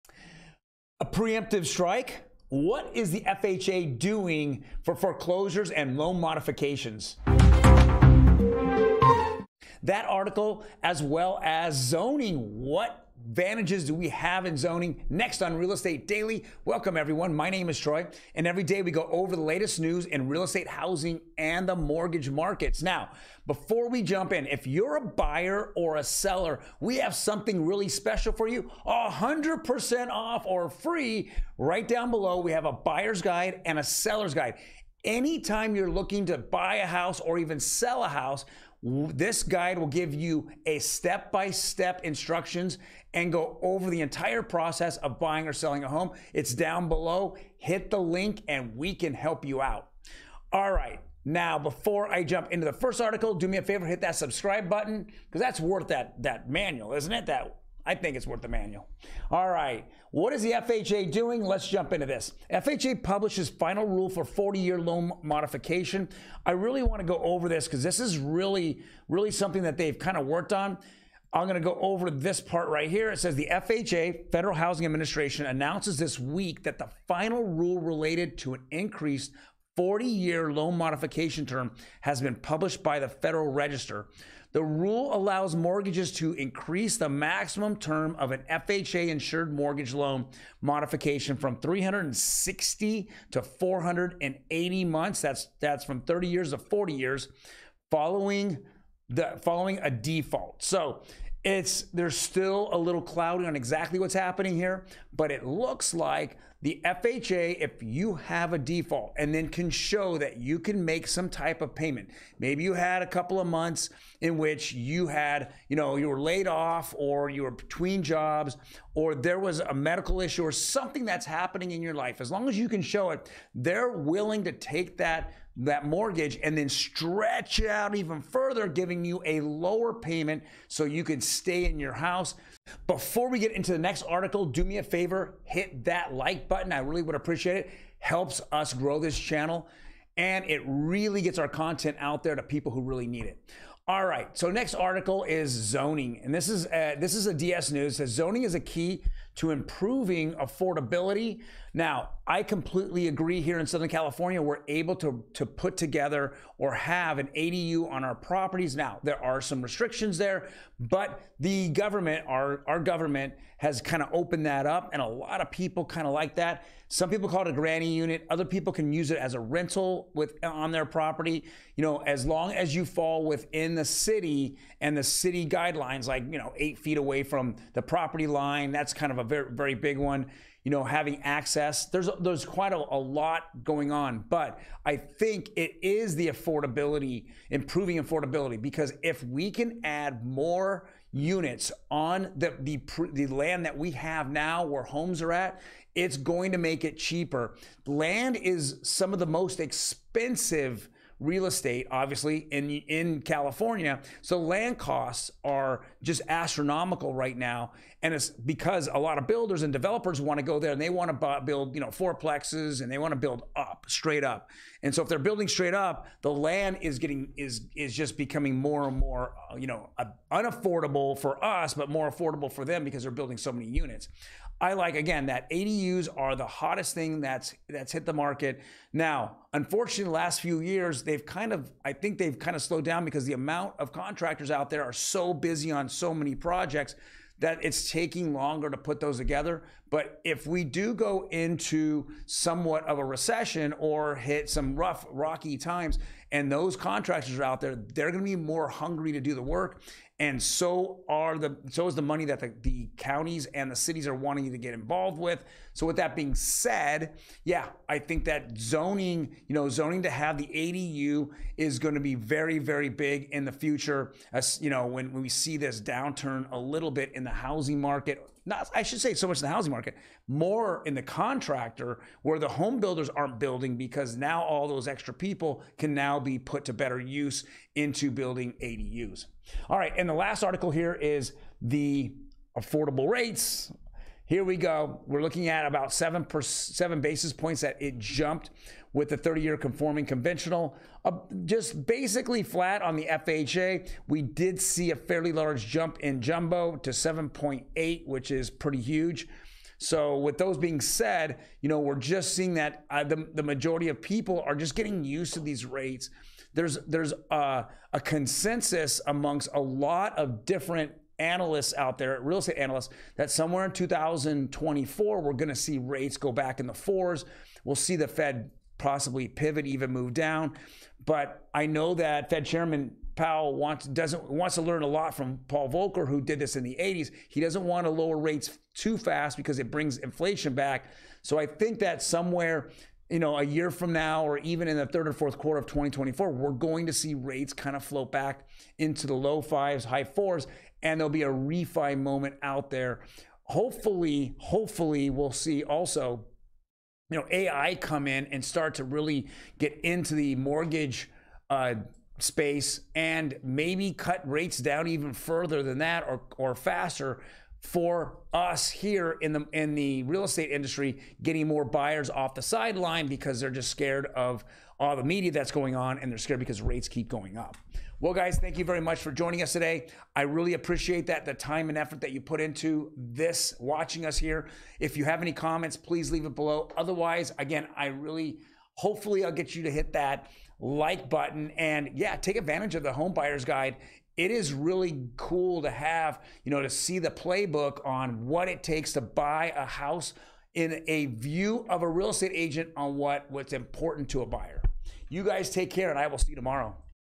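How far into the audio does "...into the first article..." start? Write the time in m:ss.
0:52.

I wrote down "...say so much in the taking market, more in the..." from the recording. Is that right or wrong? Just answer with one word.
wrong.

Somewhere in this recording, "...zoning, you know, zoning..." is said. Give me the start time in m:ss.
4:18.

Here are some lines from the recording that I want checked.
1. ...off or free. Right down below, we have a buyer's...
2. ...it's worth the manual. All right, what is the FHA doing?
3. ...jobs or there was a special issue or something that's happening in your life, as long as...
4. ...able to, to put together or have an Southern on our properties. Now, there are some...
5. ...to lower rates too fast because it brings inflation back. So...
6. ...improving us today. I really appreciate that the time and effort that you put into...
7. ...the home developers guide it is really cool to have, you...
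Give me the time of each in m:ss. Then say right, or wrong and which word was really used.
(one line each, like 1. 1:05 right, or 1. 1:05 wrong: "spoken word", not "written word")
1. 0:30 right
2. 0:58 right
3. 1:58 wrong: "medical", not "special"
4. 2:34 wrong: "ADU", not "Southern"
5. 5:27 right
6. 6:09 wrong: "joining", not "improving"
7. 6:22 wrong: "buyers", not "developers".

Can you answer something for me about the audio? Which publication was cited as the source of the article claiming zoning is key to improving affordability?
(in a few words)
DS News.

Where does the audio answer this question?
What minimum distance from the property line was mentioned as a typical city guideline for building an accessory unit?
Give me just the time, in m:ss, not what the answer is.
2:56.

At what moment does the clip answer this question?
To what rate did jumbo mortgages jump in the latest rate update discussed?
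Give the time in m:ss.
4:56.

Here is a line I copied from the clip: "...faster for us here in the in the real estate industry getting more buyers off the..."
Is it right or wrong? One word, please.
right.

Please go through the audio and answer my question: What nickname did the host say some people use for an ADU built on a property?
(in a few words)
granny unit.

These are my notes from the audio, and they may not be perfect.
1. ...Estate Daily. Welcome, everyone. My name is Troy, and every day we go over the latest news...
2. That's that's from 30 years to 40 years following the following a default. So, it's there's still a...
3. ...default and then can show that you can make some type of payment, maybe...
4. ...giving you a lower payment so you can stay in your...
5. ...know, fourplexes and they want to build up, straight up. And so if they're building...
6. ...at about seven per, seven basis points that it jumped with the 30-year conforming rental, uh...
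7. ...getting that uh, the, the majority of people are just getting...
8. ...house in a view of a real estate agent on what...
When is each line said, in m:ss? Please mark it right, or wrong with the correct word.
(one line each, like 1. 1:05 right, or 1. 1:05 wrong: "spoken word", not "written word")
1. 0:15 right
2. 1:35 right
3. 1:48 right
4. 2:08 right
5. 3:31 right
6. 4:45 wrong: "conventional", not "rental"
7. 5:02 wrong: "seeing", not "getting"
8. 6:29 right.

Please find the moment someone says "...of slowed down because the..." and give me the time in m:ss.
3:52.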